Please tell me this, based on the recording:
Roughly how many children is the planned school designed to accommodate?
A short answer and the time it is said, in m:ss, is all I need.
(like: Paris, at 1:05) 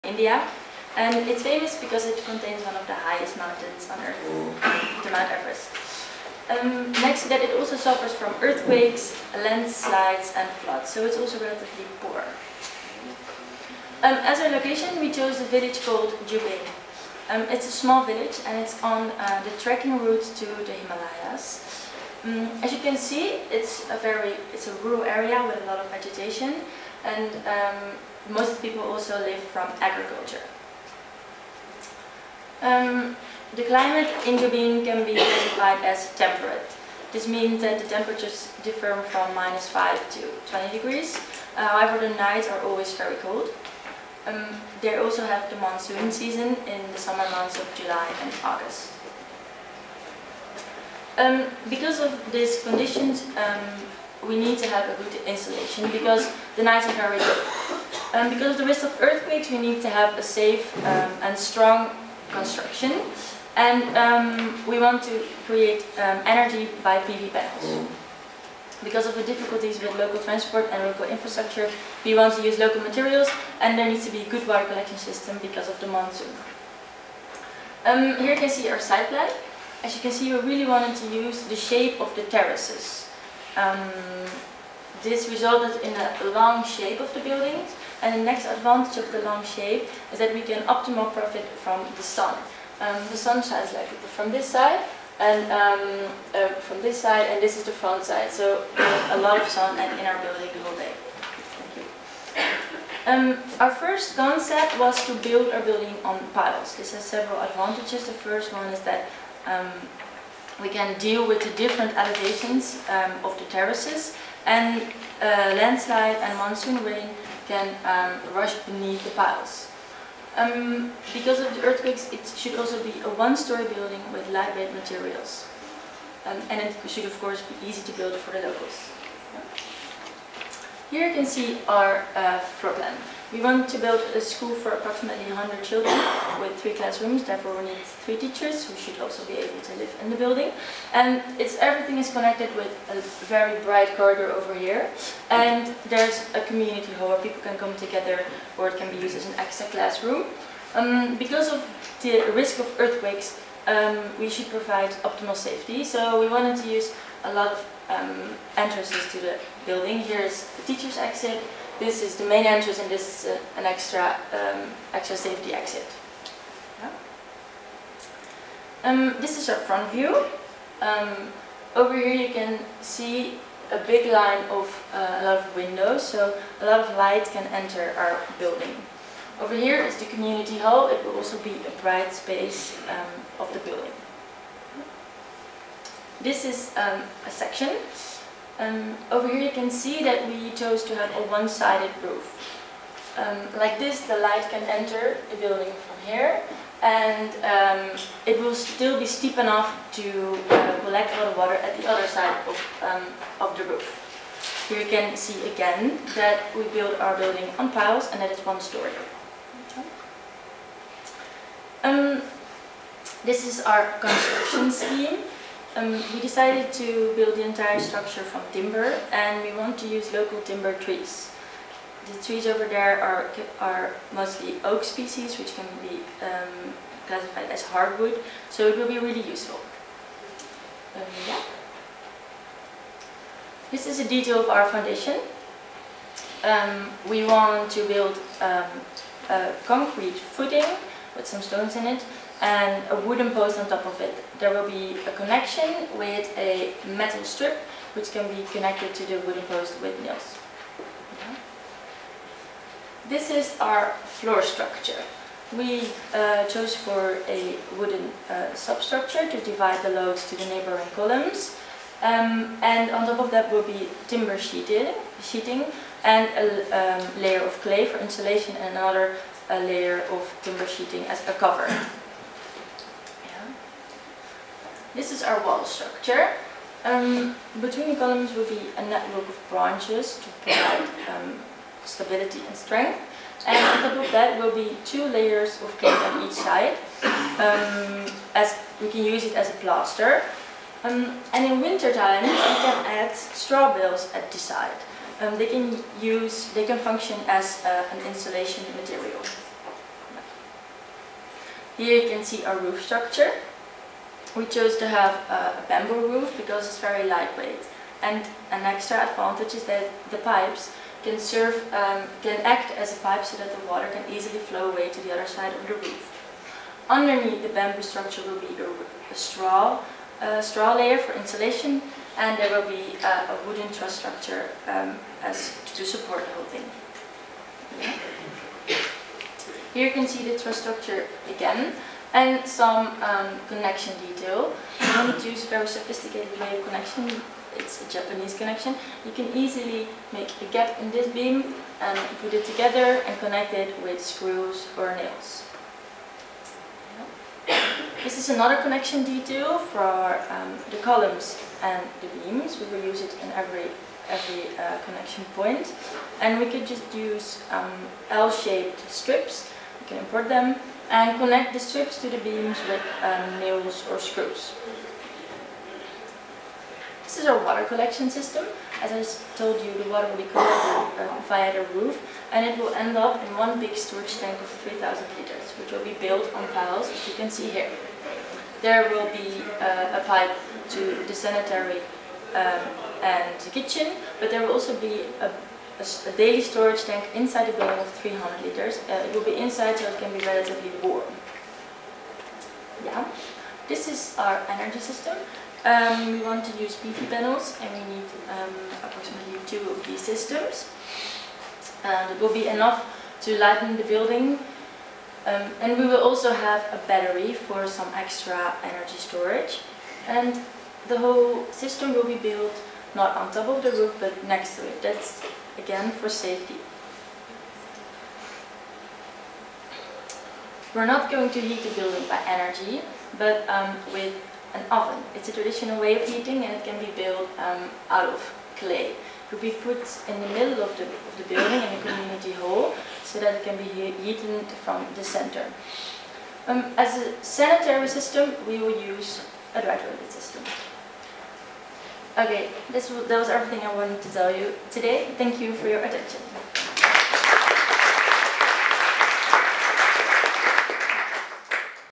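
100, at 2:15.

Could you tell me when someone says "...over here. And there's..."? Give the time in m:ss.
2:24.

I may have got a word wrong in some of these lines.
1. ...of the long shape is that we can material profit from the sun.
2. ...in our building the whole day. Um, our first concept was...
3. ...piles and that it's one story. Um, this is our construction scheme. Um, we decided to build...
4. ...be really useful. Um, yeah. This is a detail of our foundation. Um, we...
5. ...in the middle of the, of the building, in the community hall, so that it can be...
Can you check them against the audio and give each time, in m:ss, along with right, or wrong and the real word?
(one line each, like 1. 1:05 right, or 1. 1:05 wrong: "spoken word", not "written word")
1. 1:29 wrong: "optimal", not "material"
2. 1:39 right
3. 3:27 right
4. 3:48 right
5. 7:10 right.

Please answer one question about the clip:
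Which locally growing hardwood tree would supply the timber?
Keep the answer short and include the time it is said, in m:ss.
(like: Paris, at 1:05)
oak, at 3:44.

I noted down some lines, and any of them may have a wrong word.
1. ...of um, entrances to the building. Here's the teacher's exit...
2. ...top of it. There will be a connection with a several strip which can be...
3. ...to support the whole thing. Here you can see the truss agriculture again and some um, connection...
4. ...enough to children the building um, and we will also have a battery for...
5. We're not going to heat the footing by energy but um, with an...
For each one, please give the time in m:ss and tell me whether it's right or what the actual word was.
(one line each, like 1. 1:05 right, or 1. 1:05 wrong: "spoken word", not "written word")
1. 2:37 right
2. 4:03 wrong: "metal", not "several"
3. 5:25 wrong: "structure", not "agriculture"
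4. 6:42 wrong: "lighten", not "children"
5. 7:00 wrong: "building", not "footing".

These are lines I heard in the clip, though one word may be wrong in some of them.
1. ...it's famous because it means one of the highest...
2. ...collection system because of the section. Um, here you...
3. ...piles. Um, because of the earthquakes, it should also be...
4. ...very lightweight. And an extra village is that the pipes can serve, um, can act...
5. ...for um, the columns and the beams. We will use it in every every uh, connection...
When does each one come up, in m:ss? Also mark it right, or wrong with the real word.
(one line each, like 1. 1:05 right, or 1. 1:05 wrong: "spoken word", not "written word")
1. 0:01 wrong: "contains", not "means"
2. 1:14 wrong: "monsoon", not "section"
3. 1:59 right
4. 5:06 wrong: "advantage", not "village"
5. 5:49 right.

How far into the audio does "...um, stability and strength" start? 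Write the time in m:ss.
4:41.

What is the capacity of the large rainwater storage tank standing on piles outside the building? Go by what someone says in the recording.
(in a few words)
3,000 liters.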